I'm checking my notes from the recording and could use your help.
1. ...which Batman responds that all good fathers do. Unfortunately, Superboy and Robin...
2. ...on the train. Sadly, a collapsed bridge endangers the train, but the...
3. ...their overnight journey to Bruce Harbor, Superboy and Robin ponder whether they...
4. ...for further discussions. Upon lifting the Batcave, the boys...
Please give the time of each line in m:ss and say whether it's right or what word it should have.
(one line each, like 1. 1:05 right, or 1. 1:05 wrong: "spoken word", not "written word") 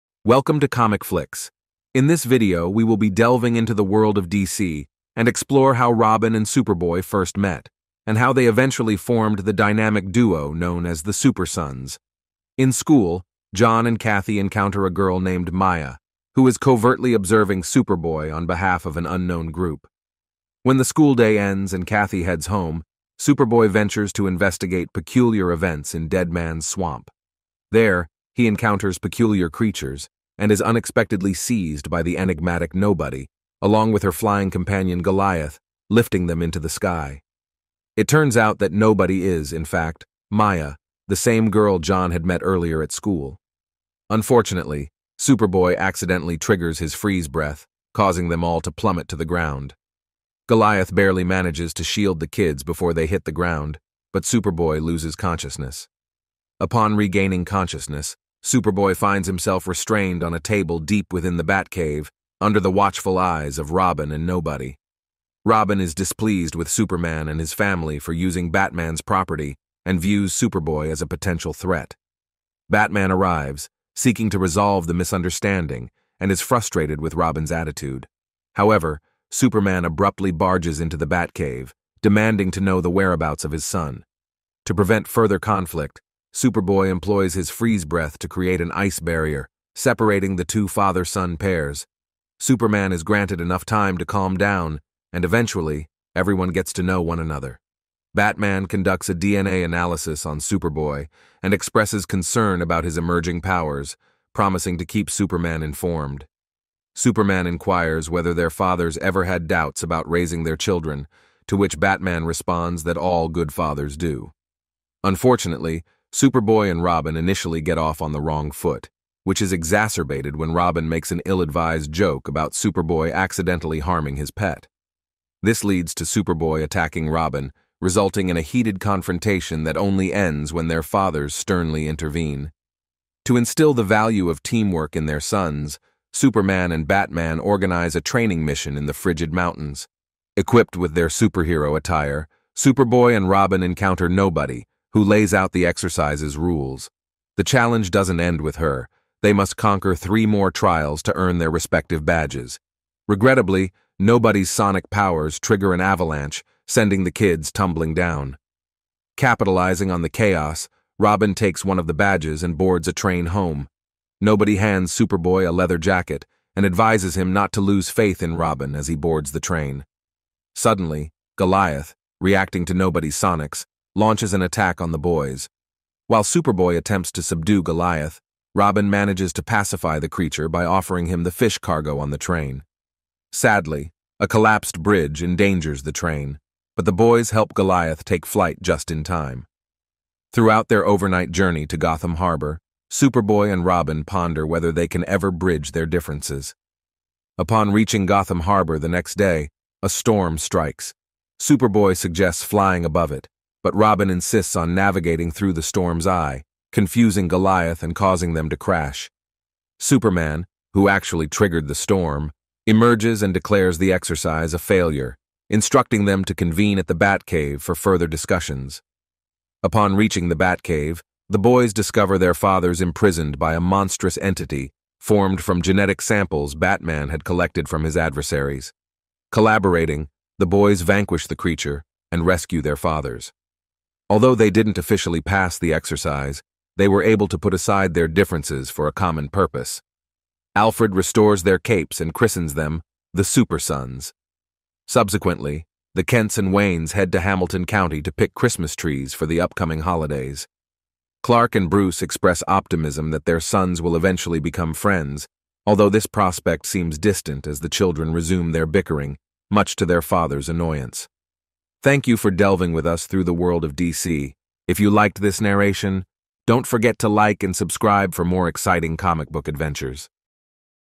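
1. 1:51 right
2. 3:01 right
3. 3:10 wrong: "Gotham", not "Bruce"
4. 3:37 wrong: "reaching", not "lifting".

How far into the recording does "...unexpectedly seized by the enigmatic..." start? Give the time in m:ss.
0:30.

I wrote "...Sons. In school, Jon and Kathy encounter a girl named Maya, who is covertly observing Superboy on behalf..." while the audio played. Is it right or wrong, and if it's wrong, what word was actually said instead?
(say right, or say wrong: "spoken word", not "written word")
right.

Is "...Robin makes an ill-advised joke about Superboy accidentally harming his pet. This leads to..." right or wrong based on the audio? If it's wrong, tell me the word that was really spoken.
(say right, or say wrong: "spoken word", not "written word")
right.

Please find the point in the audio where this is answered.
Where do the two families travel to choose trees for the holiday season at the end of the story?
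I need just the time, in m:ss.
4:07.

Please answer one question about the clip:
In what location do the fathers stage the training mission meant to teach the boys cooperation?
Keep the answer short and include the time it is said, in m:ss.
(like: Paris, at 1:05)
Frigid Mountains, at 2:18.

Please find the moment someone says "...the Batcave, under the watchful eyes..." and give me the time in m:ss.
1:01.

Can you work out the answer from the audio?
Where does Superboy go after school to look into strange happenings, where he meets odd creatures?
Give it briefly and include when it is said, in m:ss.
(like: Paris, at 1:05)
Deadman's Swamp, at 0:26.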